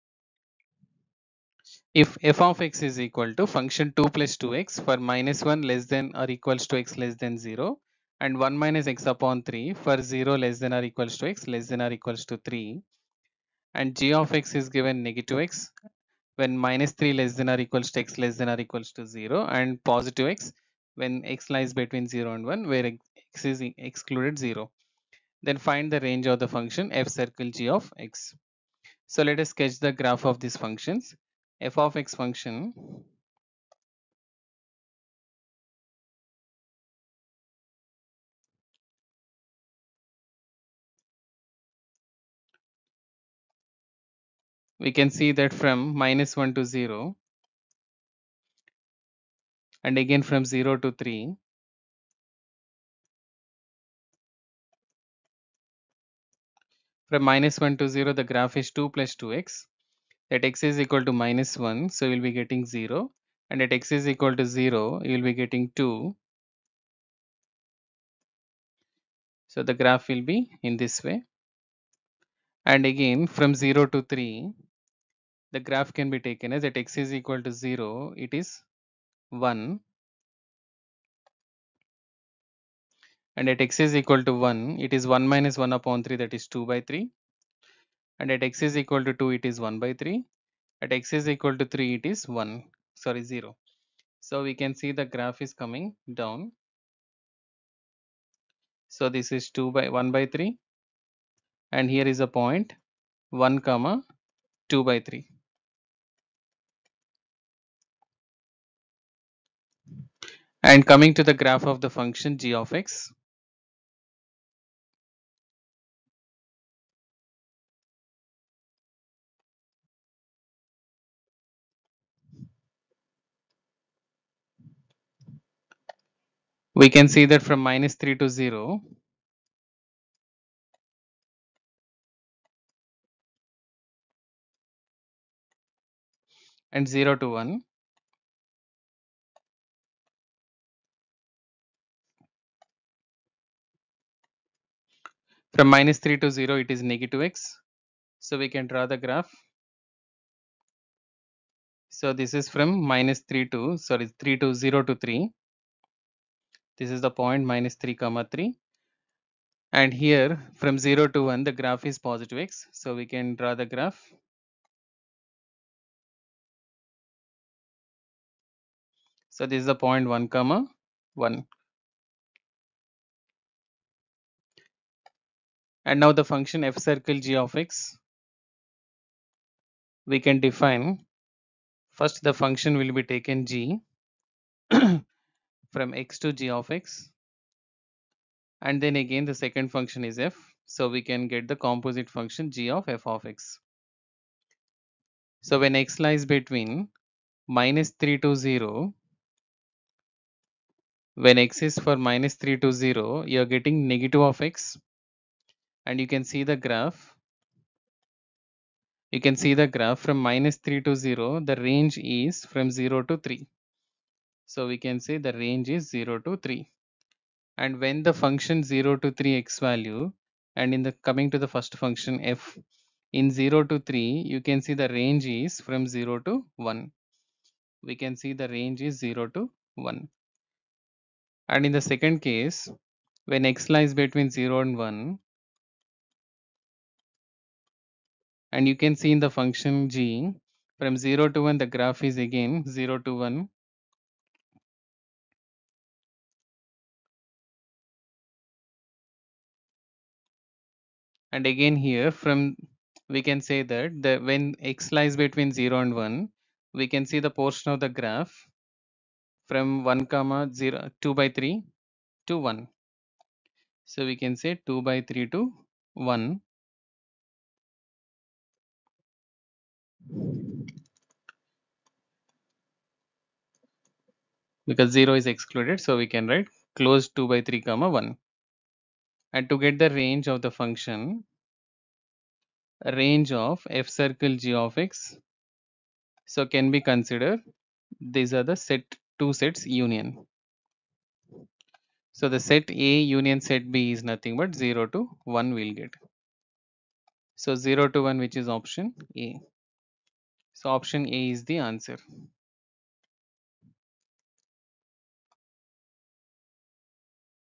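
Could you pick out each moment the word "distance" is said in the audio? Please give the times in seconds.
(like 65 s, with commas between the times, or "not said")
not said.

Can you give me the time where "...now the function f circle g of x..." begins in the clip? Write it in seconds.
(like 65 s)
175 s.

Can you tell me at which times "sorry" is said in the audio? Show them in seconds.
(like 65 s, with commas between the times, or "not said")
93 s, 153 s.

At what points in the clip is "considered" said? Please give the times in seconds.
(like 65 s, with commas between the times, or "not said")
286 s.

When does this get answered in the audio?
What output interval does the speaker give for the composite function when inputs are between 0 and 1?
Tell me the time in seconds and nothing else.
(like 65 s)
277 s.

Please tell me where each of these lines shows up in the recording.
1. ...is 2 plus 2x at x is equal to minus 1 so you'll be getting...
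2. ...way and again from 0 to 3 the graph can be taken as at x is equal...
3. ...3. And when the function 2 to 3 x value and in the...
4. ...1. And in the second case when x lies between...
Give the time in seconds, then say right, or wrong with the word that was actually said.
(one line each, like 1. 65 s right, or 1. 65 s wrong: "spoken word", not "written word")
1. 58 s right
2. 71 s right
3. 216 s wrong: "0", not "2"
4. 229 s right.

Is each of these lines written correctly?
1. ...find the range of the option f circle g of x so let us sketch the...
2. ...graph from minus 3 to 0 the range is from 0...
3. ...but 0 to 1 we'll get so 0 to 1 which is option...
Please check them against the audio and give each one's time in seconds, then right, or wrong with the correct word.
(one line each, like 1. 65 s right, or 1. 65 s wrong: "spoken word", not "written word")
1. 25 s wrong: "function", not "option"
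2. 209 s right
3. 294 s right.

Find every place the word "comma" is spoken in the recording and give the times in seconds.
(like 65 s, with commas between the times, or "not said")
103 s, 157 s, 170 s, 260 s, 277 s.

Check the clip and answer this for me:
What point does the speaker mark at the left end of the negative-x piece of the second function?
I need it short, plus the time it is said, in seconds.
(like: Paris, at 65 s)
(-3, 3), at 157 s.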